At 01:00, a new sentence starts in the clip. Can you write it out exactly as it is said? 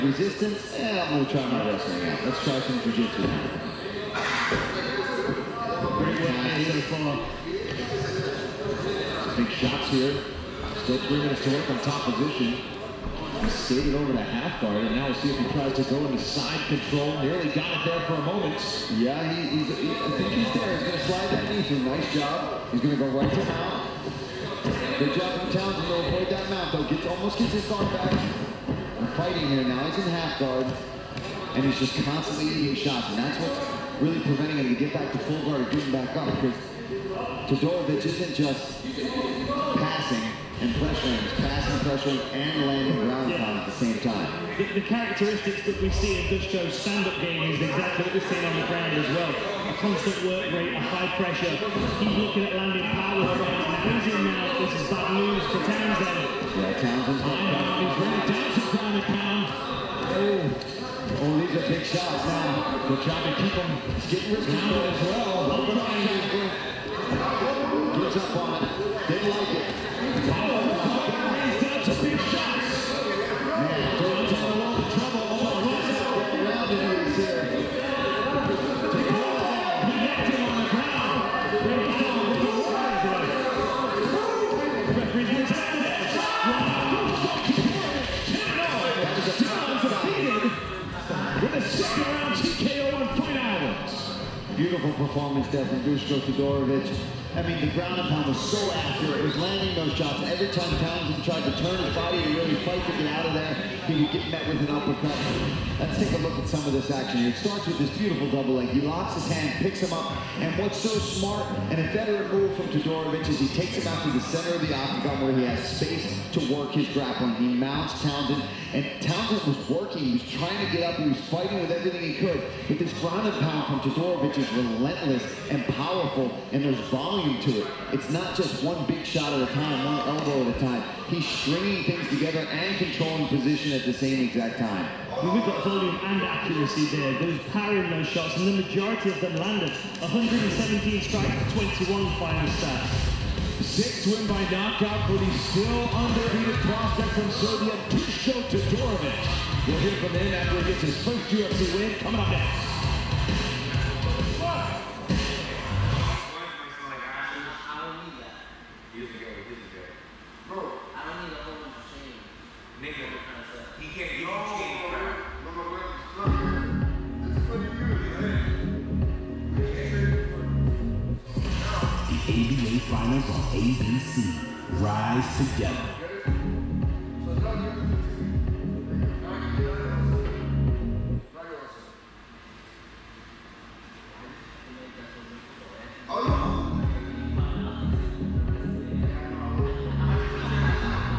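Oh, oh, these are big shots now.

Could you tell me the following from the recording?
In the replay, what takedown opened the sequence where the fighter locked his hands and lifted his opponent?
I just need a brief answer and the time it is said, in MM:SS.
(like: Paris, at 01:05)
Double leg, at 01:48.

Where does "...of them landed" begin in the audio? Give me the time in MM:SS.
02:19.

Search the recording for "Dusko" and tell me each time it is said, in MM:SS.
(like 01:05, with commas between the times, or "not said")
00:46, 01:35.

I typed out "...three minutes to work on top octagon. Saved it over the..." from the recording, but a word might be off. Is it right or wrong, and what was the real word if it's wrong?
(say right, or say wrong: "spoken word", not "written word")
wrong: "position", not "octagon".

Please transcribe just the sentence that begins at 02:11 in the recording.
He's stringing things together and controlling position at the same exact time.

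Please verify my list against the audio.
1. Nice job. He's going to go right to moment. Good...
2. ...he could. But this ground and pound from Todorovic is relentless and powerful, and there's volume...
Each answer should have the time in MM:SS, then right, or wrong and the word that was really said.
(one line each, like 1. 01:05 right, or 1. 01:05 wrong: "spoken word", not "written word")
1. 00:21 wrong: "mount", not "moment"
2. 02:02 right.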